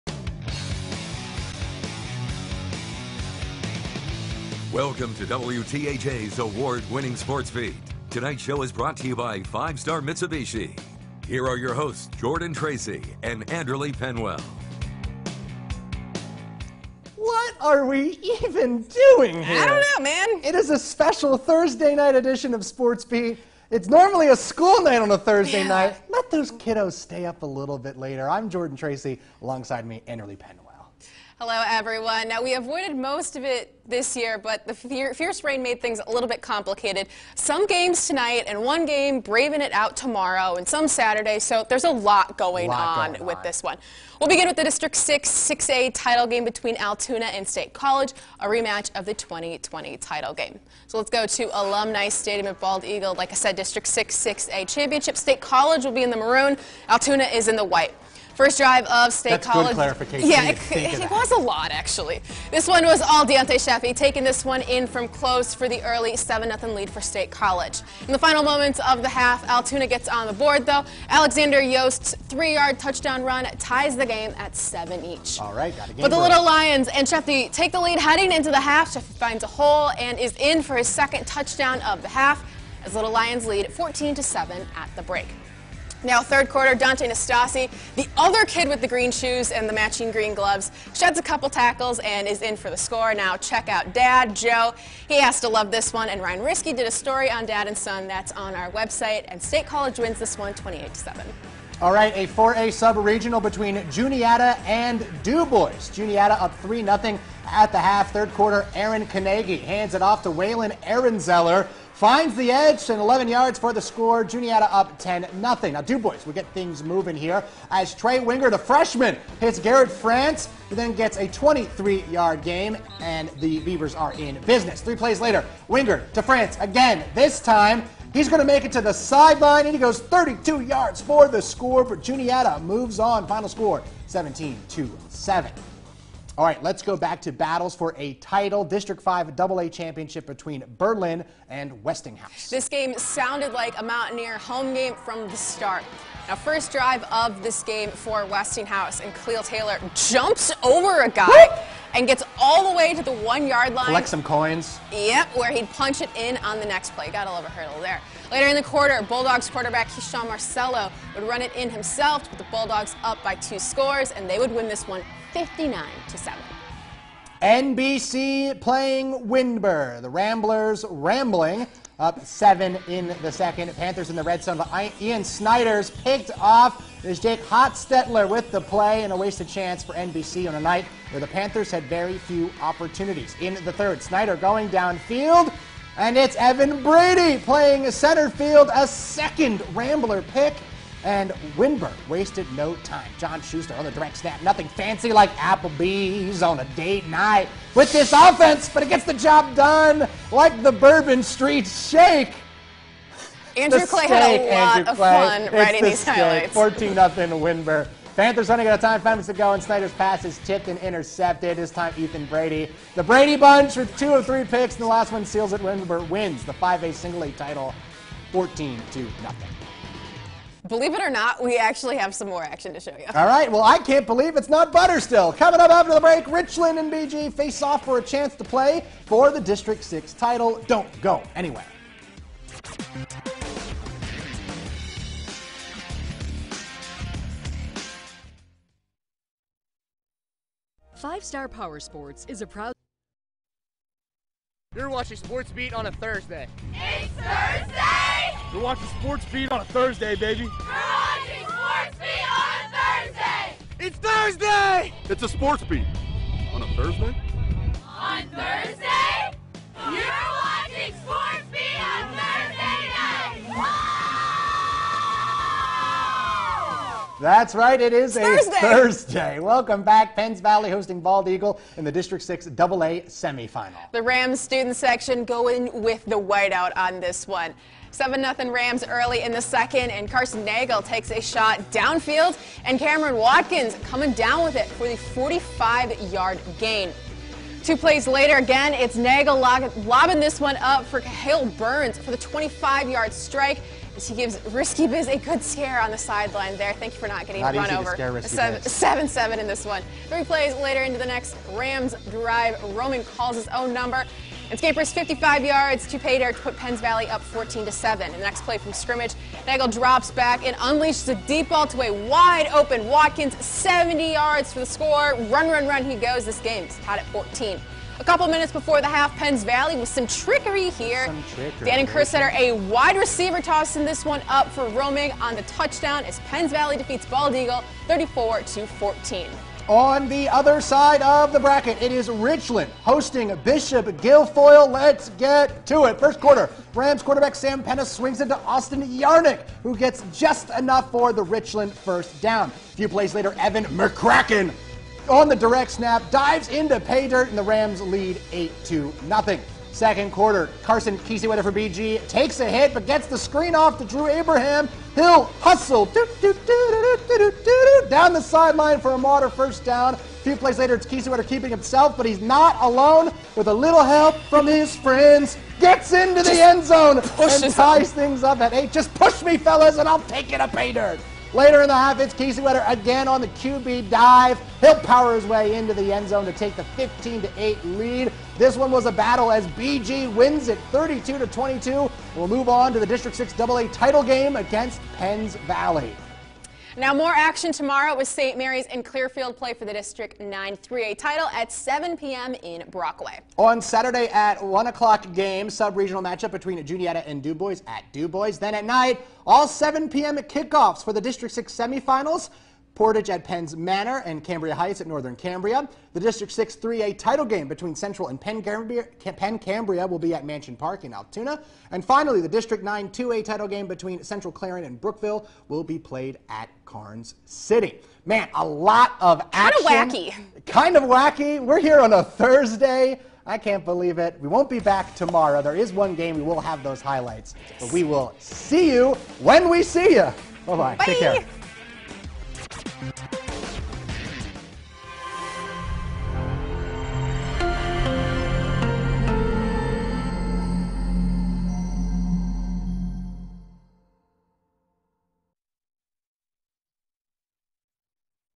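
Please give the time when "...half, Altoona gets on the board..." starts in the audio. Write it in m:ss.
1:09.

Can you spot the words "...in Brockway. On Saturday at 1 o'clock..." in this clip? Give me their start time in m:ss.
6:32.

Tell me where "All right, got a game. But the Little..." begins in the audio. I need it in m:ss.
1:15.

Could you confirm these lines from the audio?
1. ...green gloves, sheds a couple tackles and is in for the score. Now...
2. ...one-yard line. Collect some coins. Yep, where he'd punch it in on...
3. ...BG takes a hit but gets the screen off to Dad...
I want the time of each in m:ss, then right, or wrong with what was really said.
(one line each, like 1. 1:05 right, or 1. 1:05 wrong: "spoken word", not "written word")
1. 1:30 right
2. 2:33 right
3. 5:51 wrong: "Drew", not "Dad".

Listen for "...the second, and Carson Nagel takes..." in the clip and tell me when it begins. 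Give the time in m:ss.
4:39.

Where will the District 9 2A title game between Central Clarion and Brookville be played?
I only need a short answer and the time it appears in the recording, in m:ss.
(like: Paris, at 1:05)
Karns City, at 6:56.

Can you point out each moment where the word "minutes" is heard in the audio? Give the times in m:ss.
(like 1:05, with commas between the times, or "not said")
3:29, 5:18.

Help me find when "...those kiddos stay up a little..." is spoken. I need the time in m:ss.
0:26.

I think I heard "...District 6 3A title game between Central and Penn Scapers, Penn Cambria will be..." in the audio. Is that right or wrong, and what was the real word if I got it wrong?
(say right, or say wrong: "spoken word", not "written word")
wrong: "Cambria", not "Scapers".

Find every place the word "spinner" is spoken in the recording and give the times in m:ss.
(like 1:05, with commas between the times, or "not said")
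not said.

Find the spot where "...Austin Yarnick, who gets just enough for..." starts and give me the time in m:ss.
5:38.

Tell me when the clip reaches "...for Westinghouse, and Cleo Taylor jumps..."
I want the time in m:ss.
2:27.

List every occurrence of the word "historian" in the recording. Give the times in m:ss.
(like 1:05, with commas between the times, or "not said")
not said.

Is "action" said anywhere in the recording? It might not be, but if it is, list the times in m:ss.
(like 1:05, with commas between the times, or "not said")
3:42, 6:27, 6:59.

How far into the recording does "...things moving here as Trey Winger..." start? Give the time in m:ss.
1:56.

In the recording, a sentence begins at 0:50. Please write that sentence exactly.
So let's go to Alumni Stadium at Bald Eagle.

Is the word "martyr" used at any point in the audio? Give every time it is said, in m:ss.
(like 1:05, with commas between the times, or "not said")
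5:58.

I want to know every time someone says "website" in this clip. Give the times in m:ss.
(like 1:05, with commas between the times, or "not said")
1:38.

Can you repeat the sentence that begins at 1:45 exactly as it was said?
Juniata up 3-0 at the half.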